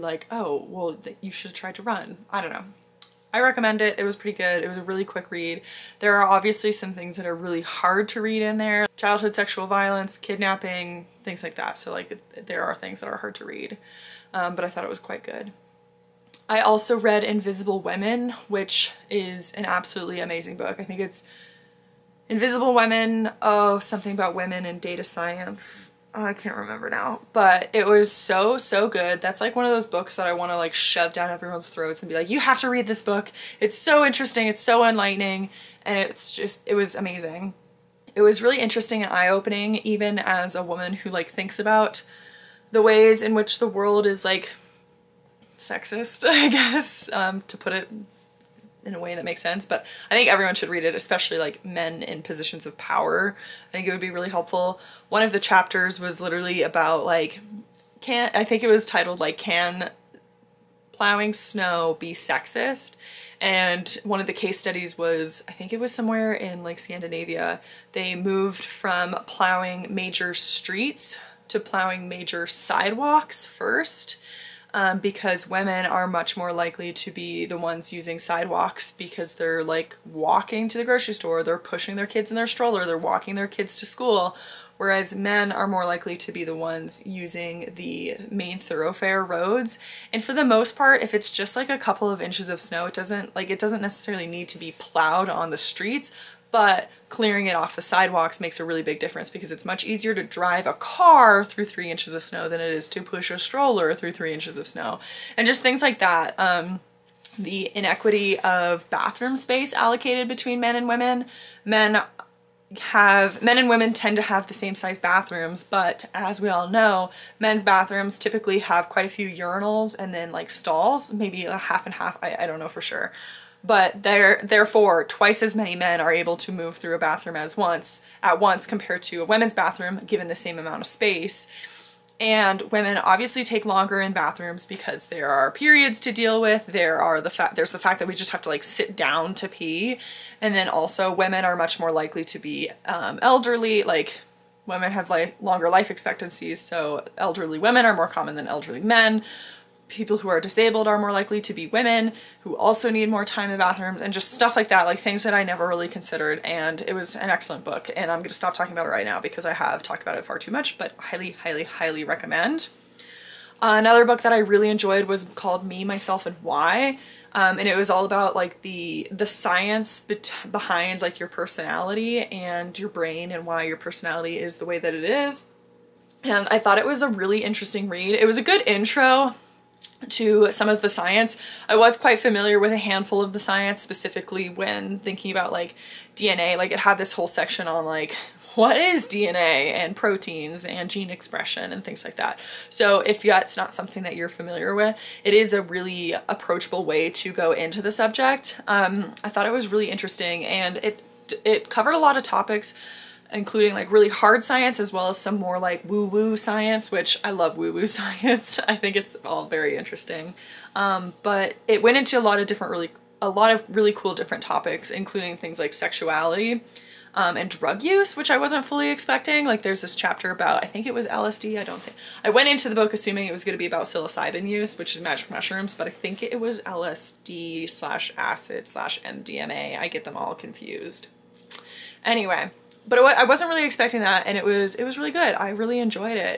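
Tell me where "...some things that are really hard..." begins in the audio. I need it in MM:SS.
00:06.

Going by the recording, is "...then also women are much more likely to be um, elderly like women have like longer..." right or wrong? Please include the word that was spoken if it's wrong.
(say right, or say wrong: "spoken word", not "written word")
right.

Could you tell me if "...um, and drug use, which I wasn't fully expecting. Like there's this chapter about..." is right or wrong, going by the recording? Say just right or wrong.
right.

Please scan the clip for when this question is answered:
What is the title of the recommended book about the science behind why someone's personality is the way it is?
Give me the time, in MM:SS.
02:45.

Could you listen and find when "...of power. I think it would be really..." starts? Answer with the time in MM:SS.
00:52.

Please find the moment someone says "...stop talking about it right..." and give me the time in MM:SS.
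02:38.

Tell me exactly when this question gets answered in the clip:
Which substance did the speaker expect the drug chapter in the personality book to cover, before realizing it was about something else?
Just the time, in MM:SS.
03:43.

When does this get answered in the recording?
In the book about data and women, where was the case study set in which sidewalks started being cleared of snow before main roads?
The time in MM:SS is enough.
01:06.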